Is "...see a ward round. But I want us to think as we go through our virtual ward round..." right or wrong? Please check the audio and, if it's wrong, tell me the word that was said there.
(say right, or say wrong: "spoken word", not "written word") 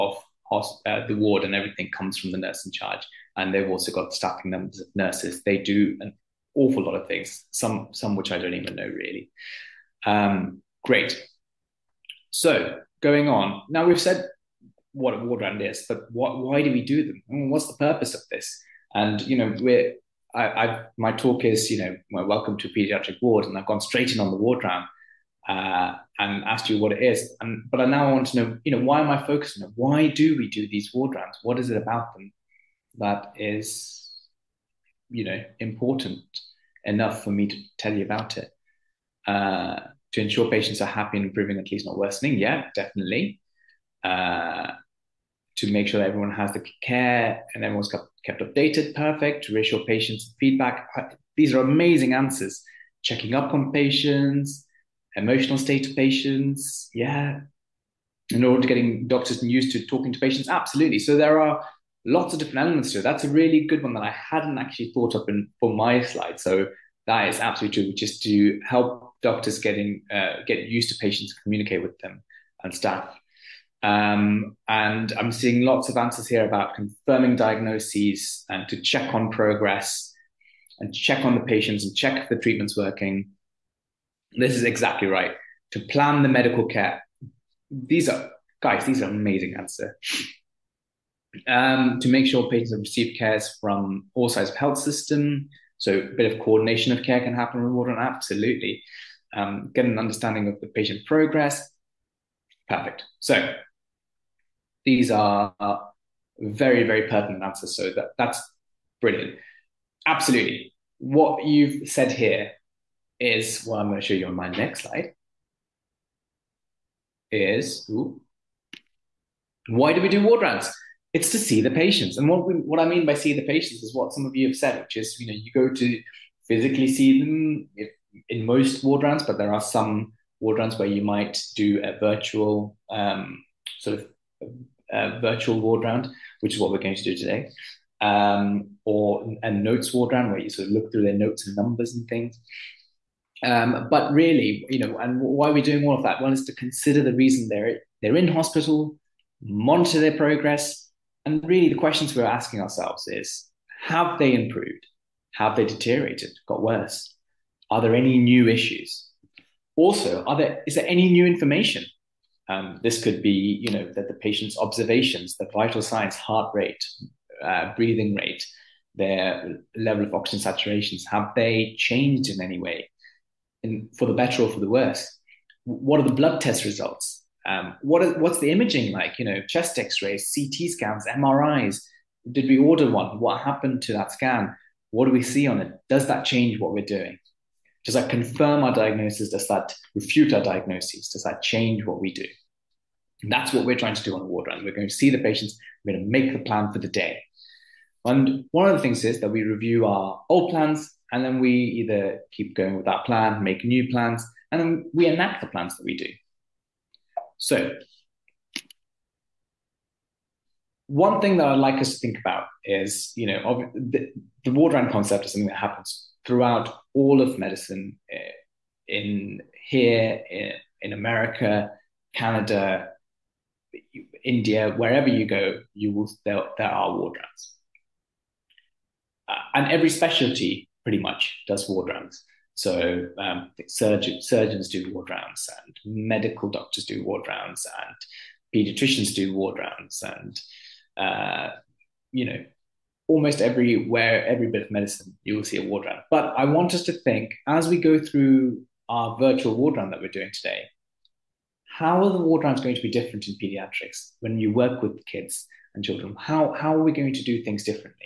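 right.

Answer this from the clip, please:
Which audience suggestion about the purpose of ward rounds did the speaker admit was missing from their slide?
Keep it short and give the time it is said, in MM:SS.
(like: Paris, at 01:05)
getting doctors used to talking to patients, at 00:58.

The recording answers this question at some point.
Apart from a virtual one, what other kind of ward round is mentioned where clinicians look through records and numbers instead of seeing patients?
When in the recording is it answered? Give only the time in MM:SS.
02:19.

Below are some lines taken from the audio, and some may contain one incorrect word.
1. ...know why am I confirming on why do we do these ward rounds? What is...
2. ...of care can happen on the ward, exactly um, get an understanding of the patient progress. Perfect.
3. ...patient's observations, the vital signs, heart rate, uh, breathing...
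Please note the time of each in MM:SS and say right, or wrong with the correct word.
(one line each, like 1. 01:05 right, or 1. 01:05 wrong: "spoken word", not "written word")
1. 00:28 wrong: "focusing", not "confirming"
2. 01:36 wrong: "absolutely", not "exactly"
3. 02:44 right.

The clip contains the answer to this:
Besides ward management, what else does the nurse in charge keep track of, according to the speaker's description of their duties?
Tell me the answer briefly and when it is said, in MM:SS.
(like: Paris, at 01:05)
staffing numbers, at 00:04.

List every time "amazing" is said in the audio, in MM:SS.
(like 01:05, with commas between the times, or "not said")
00:51, 01:29.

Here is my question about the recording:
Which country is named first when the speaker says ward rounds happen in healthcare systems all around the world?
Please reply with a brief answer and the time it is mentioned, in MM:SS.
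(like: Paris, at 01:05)
America, at 03:40.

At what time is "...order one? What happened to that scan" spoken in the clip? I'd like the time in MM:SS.
03:02.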